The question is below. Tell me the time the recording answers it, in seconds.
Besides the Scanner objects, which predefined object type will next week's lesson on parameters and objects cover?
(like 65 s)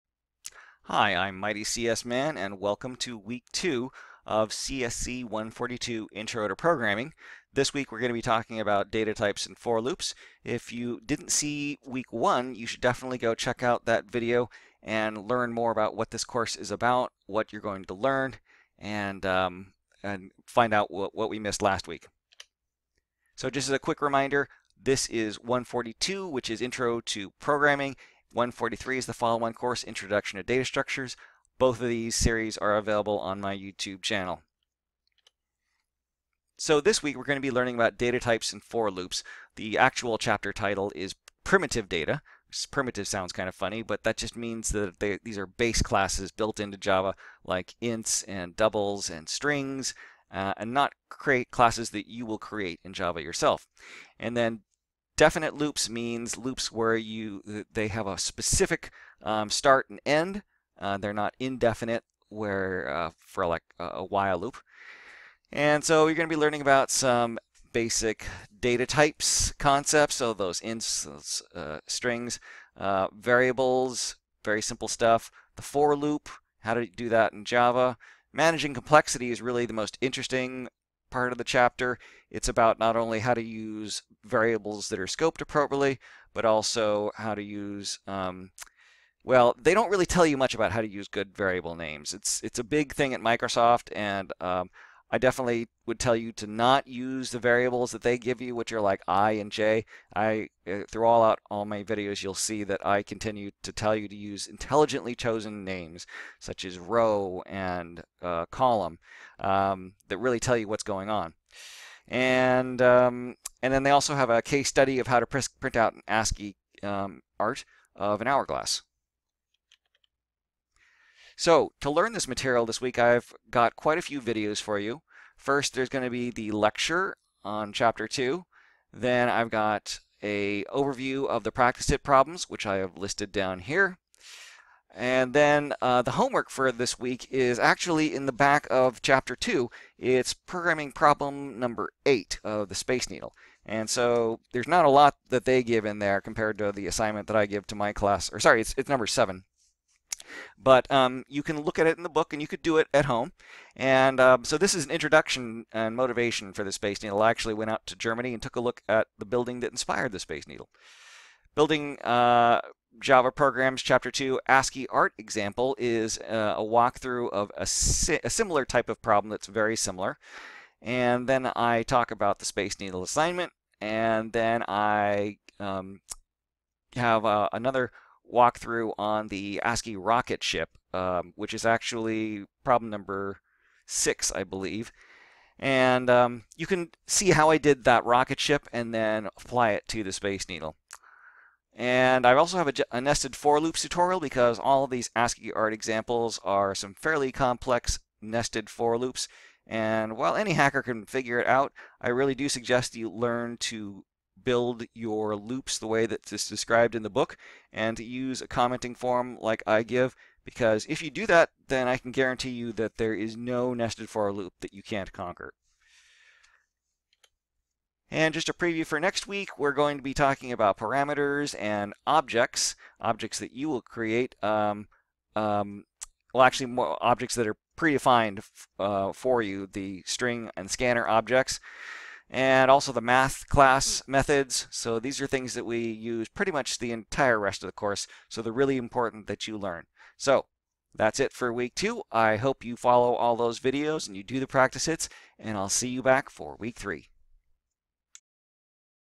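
230 s.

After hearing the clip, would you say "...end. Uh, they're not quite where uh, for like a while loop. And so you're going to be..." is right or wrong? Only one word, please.
wrong.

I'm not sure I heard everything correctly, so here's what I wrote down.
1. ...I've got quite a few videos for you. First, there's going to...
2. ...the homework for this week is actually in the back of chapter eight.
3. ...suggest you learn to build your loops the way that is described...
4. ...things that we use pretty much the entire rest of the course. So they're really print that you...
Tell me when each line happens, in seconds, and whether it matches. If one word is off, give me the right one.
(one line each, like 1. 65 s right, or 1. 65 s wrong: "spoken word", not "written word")
1. 122 s right
2. 136 s wrong: "two", not "eight"
3. 202 s right
4. 235 s wrong: "important", not "print".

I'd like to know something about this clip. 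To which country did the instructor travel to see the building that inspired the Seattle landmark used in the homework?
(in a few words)
Germany.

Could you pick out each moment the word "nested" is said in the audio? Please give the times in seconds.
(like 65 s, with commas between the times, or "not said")
192 s, 198 s, 213 s.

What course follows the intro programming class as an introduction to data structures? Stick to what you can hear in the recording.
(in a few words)
CSC 143.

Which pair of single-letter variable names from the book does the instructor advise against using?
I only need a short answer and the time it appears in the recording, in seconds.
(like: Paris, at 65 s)
i and j, at 99 s.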